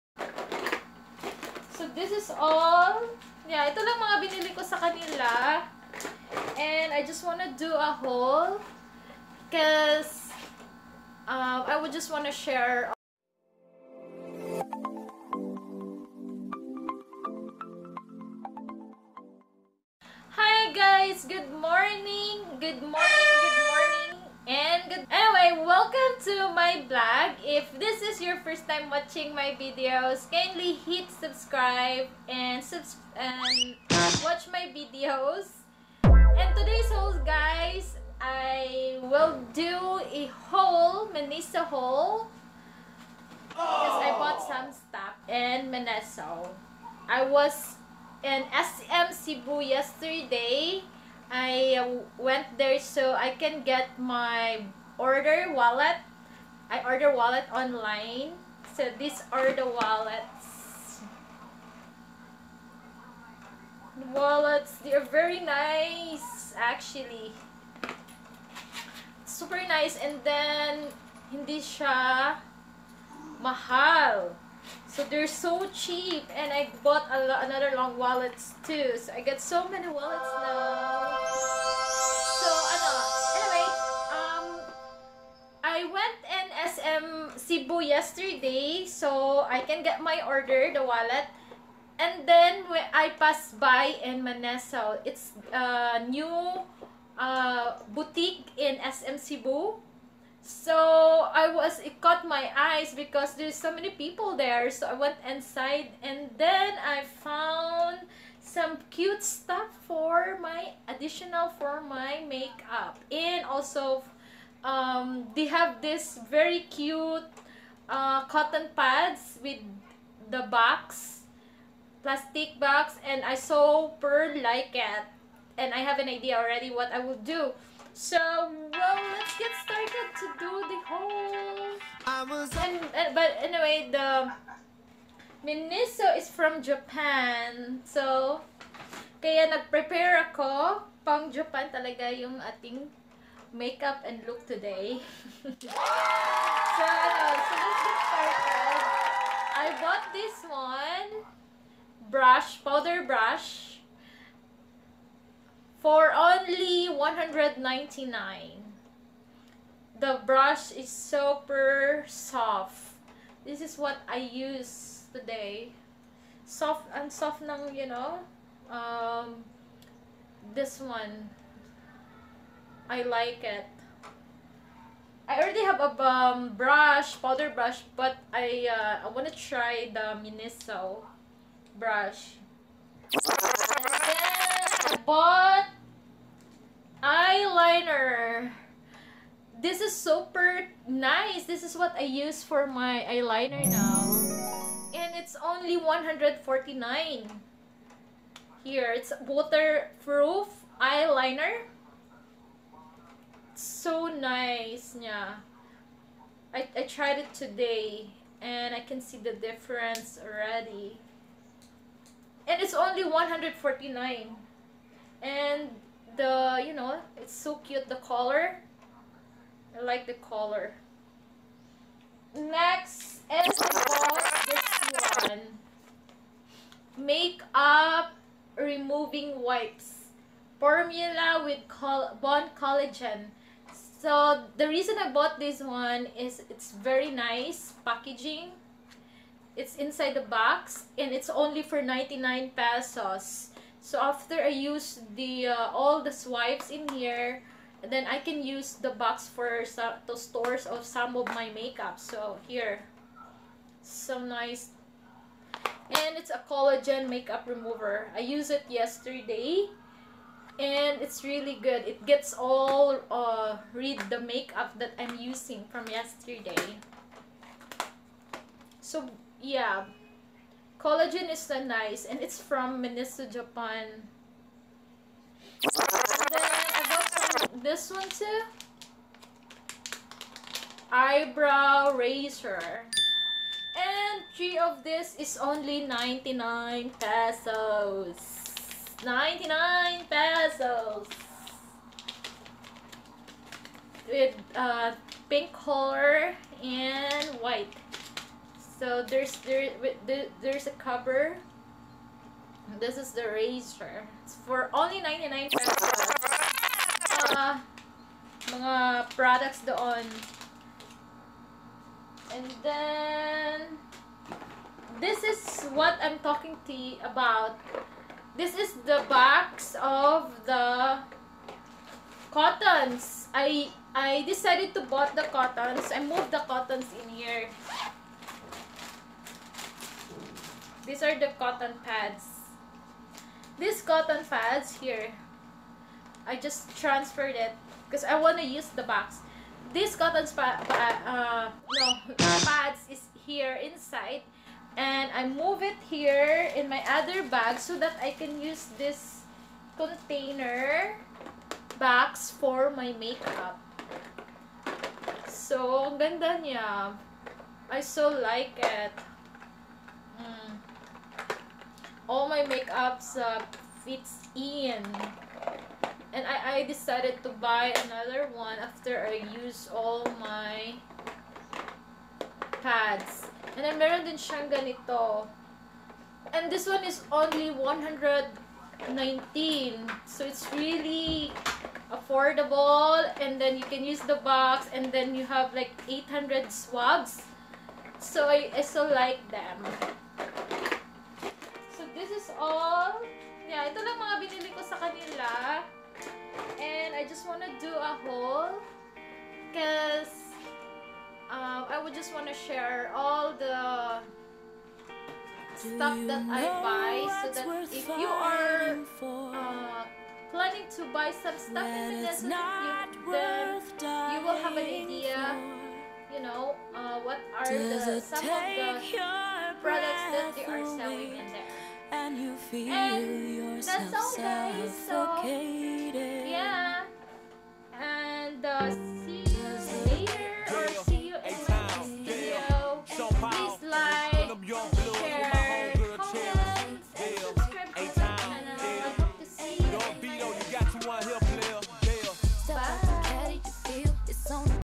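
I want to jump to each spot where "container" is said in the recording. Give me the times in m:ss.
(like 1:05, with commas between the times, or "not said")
5:49.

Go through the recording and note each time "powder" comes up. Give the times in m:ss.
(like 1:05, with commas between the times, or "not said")
2:32, 2:57.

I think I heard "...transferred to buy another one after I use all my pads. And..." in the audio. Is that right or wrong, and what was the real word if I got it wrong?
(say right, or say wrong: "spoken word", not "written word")
wrong: "decided", not "transferred".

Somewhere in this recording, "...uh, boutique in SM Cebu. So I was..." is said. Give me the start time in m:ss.
1:37.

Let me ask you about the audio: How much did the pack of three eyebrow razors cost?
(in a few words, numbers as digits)
99 pesos.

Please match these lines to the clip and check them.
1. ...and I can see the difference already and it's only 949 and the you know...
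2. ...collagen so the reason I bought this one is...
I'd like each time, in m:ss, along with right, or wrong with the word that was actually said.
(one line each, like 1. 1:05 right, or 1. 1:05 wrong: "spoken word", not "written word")
1. 3:28 wrong: "149", not "949"
2. 3:52 right.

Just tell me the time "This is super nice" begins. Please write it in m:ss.
3:09.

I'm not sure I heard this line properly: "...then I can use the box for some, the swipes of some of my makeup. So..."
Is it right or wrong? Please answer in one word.
wrong.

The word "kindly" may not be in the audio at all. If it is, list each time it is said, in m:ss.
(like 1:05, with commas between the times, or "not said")
0:30.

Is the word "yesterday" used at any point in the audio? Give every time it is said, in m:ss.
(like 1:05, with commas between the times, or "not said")
0:49, 1:27, 4:18, 4:25.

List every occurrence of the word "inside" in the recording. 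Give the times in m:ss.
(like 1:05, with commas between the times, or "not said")
1:45, 3:59, 5:43.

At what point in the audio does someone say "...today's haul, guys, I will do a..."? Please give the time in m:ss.
0:36.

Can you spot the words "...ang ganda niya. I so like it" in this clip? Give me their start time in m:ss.
5:55.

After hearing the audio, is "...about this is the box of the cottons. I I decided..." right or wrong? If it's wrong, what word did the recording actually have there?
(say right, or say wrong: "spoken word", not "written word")
right.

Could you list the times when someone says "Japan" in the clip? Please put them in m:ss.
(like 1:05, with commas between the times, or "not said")
2:16, 2:21, 4:33.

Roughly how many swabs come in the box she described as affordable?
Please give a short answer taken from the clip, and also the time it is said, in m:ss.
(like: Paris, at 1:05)
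800, at 6:25.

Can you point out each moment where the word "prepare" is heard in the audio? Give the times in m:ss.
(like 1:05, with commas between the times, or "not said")
2:19.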